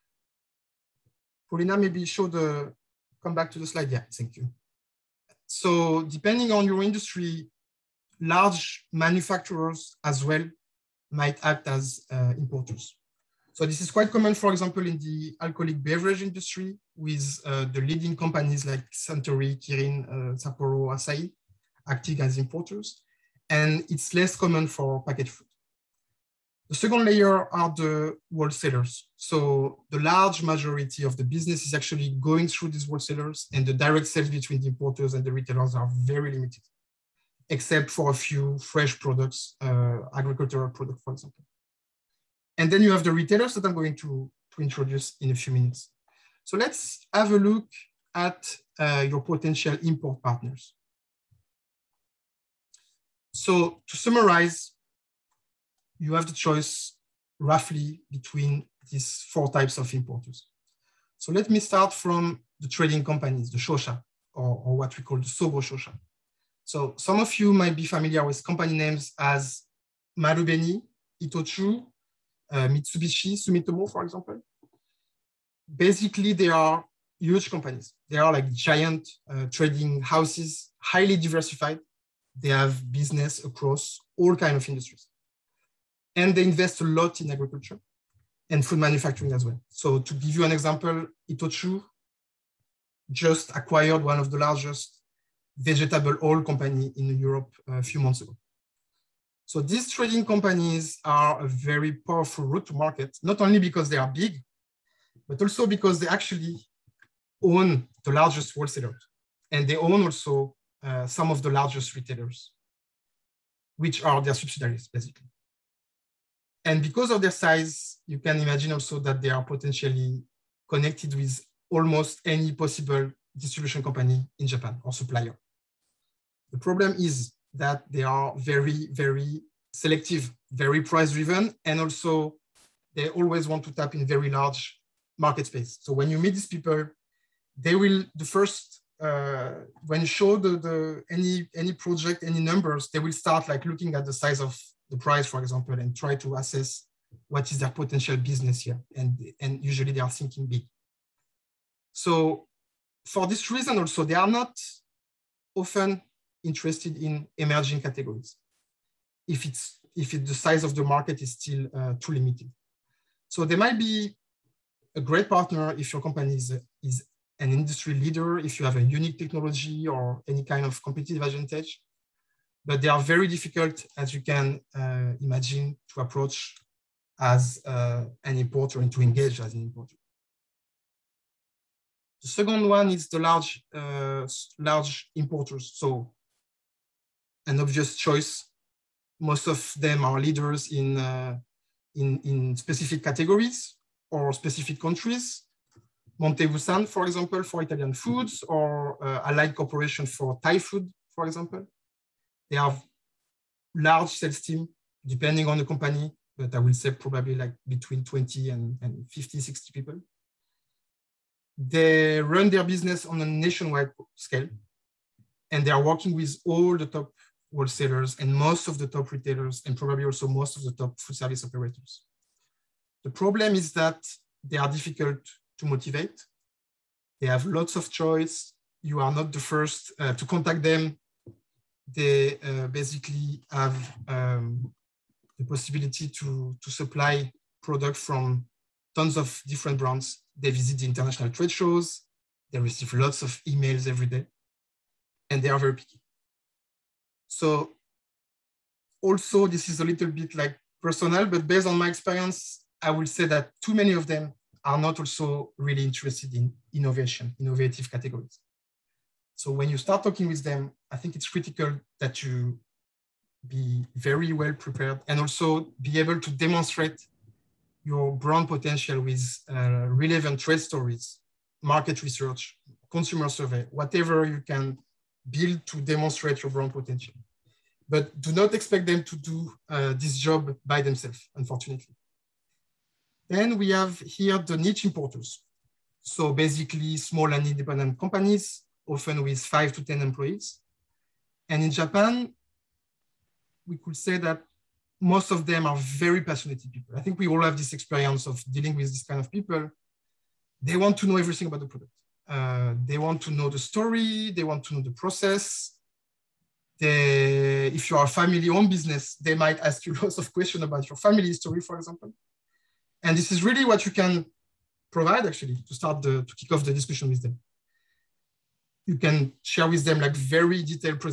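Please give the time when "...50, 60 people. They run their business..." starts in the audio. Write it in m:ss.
3:29.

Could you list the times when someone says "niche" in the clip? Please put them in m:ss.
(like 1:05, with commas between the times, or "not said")
4:44.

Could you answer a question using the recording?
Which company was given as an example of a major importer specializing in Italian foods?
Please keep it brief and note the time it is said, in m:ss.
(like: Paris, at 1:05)
Monte Bussan, at 3:16.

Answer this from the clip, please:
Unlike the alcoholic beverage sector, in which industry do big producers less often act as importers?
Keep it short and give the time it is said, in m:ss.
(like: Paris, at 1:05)
Packaged food, at 0:25.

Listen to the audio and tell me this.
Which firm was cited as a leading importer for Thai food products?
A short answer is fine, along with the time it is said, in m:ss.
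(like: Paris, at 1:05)
Allied Corporation, at 3:19.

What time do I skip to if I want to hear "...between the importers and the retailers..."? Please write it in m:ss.
0:34.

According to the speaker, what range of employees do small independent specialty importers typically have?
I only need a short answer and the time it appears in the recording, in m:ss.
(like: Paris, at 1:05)
5 to 10, at 4:49.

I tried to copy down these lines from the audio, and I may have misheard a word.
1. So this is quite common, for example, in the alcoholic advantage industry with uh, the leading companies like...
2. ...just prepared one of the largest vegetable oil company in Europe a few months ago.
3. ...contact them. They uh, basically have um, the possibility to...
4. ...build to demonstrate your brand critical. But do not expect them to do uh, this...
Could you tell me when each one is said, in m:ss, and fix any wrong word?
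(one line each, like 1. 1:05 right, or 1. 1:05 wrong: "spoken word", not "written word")
1. 0:13 wrong: "beverage", not "advantage"
2. 1:33 wrong: "acquired", not "prepared"
3. 3:50 right
4. 4:35 wrong: "potential", not "critical".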